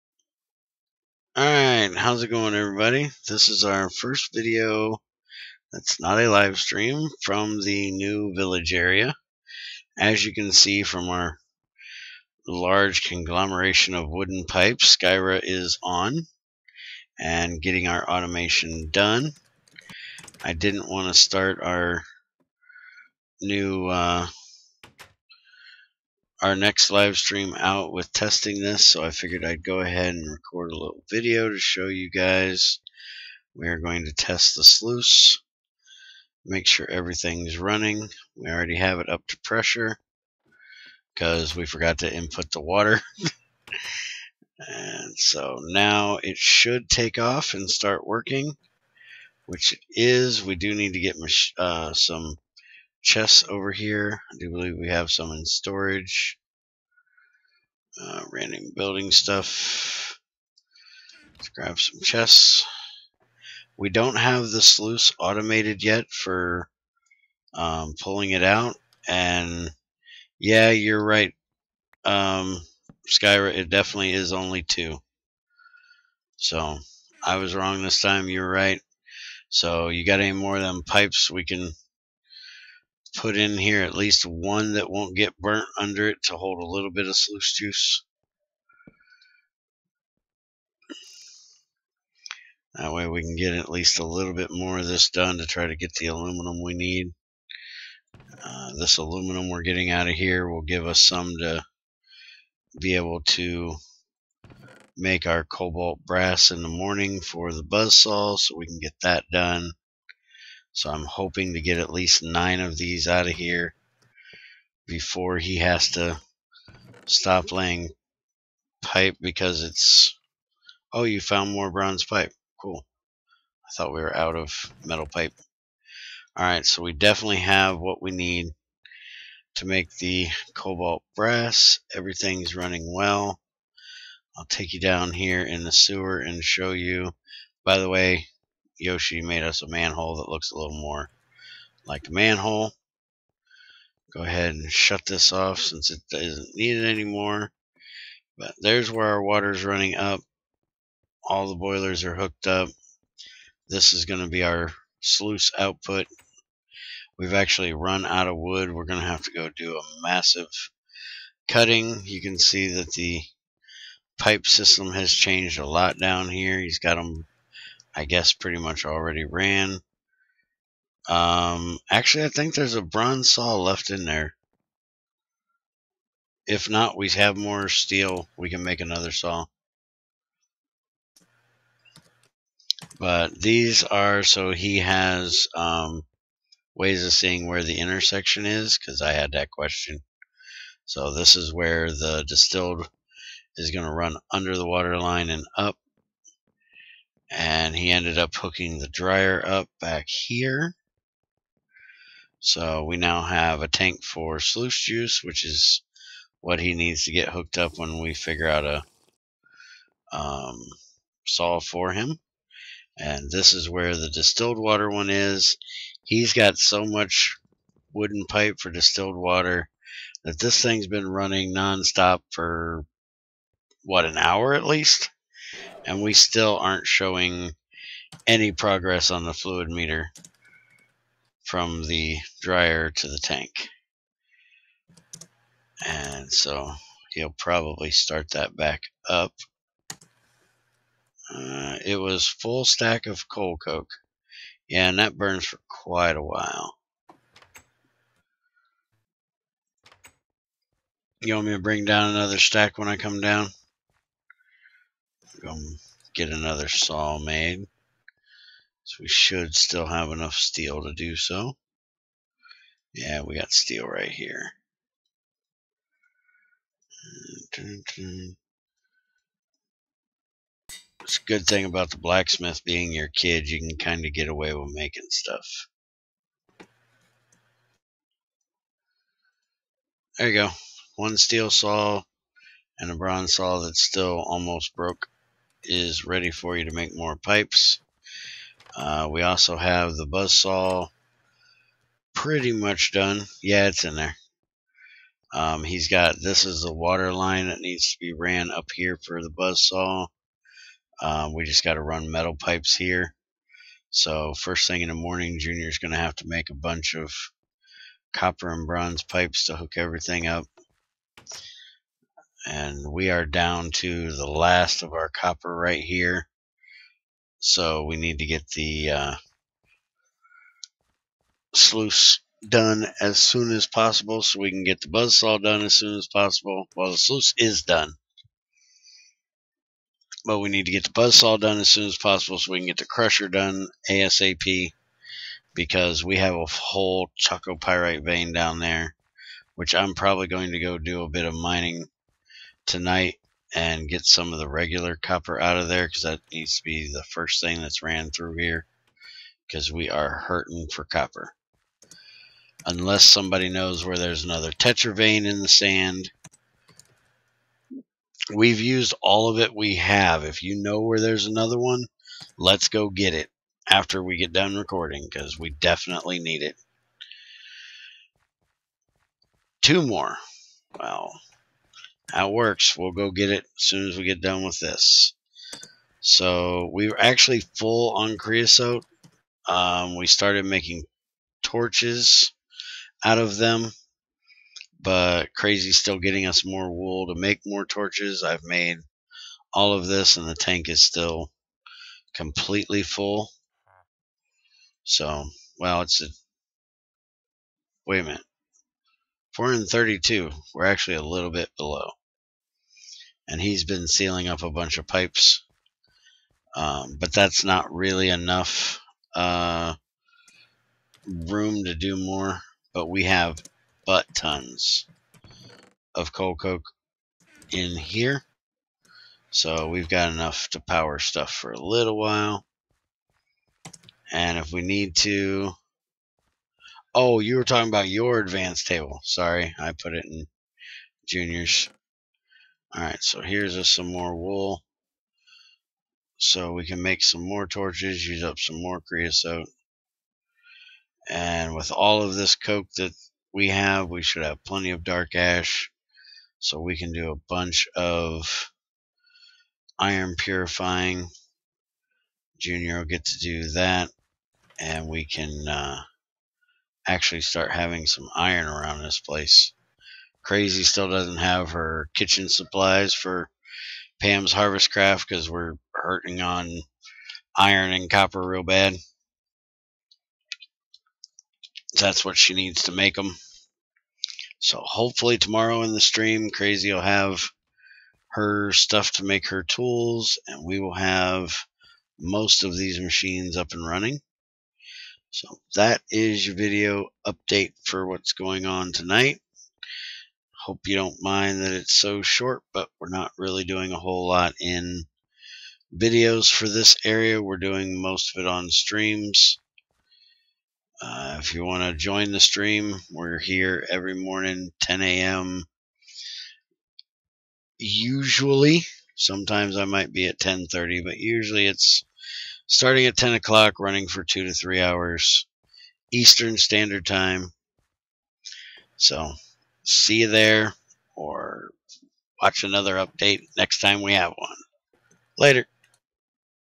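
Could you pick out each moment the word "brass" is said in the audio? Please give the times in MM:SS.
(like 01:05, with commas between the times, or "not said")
01:46, 02:11.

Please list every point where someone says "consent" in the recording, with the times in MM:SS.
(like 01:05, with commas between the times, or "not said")
not said.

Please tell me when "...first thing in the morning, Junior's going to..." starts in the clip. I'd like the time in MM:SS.
05:04.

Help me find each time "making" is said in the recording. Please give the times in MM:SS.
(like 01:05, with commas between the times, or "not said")
04:34, 06:20.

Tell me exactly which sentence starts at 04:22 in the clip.
Yeah, we got steel right here.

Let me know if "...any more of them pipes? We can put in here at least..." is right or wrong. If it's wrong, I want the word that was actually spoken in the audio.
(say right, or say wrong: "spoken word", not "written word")
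right.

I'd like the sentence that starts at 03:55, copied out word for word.
And so he'll probably start that back up.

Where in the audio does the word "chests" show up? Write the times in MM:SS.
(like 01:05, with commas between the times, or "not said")
00:53, 01:02.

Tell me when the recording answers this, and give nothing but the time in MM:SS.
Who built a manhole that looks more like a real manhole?
02:18.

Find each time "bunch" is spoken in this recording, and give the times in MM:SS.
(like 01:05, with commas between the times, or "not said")
05:06, 06:44, 07:27.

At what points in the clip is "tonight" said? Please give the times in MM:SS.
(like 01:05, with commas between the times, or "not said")
05:42, 08:08.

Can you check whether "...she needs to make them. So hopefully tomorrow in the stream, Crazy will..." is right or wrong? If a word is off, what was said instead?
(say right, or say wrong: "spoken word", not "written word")
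right.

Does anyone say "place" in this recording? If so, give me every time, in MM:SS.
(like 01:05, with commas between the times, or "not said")
07:39.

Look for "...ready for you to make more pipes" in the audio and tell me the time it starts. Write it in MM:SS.
04:46.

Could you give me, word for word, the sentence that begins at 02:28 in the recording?
But there's where our water's running up.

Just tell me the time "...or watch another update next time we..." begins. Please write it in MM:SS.
08:40.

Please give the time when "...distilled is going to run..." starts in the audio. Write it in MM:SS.
03:12.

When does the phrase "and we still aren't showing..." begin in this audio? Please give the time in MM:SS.
03:45.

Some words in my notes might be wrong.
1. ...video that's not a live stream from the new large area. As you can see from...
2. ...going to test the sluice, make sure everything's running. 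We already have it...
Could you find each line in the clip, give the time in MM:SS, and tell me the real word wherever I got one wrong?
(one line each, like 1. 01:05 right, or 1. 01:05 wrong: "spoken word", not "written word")
1. 00:04 wrong: "village", not "large"
2. 00:33 right.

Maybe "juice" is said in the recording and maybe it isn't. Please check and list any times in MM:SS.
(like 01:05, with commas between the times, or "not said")
01:27, 03:24.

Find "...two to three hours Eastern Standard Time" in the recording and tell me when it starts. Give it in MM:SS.
08:34.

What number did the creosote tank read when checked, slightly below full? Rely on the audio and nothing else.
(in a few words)
432.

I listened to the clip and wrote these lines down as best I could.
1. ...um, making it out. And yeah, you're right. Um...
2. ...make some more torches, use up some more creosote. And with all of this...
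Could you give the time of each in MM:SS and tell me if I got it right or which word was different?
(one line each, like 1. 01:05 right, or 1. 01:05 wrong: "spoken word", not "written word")
1. 01:07 wrong: "pulling", not "making"
2. 07:16 right.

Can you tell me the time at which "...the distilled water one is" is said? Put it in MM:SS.
03:33.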